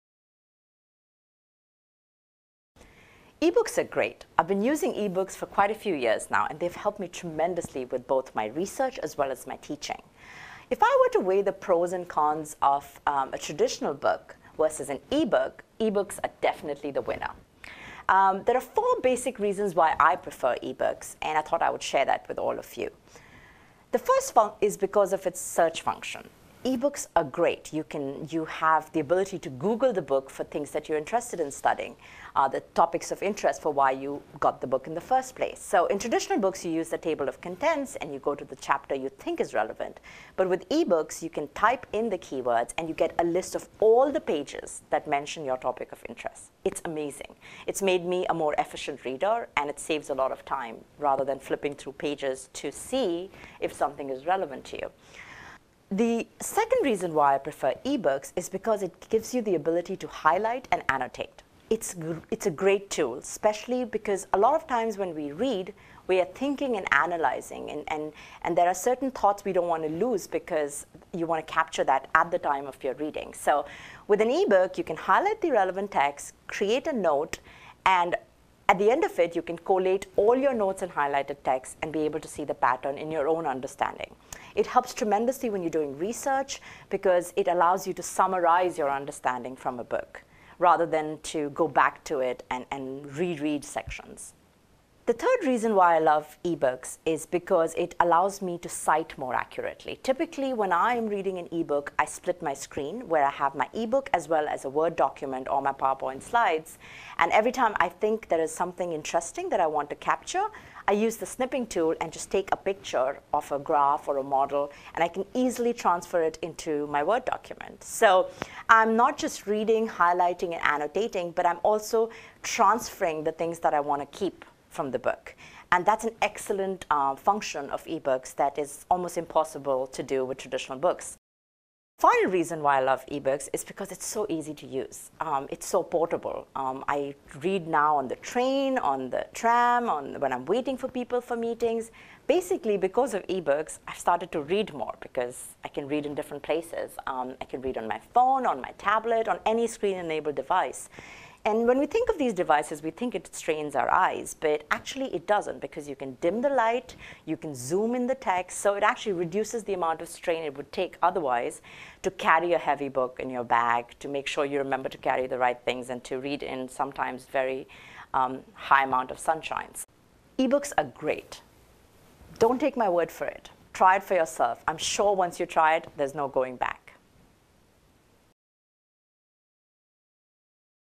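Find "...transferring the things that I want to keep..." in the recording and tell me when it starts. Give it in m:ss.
2:02.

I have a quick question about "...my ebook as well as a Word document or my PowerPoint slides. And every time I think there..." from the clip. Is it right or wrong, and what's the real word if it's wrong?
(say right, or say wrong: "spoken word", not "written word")
right.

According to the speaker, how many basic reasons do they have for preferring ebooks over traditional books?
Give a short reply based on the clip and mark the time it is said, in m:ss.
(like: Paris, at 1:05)
4, at 0:18.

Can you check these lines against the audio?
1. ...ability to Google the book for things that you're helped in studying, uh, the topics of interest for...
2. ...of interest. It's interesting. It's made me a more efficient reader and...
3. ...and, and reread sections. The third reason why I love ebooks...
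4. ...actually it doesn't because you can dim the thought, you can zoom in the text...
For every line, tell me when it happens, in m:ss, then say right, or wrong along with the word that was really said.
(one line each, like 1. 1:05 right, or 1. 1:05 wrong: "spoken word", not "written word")
1. 0:28 wrong: "interested", not "helped"
2. 0:45 wrong: "amazing", not "interesting"
3. 1:32 right
4. 2:34 wrong: "light", not "thought".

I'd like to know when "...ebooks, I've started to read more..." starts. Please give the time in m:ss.
2:23.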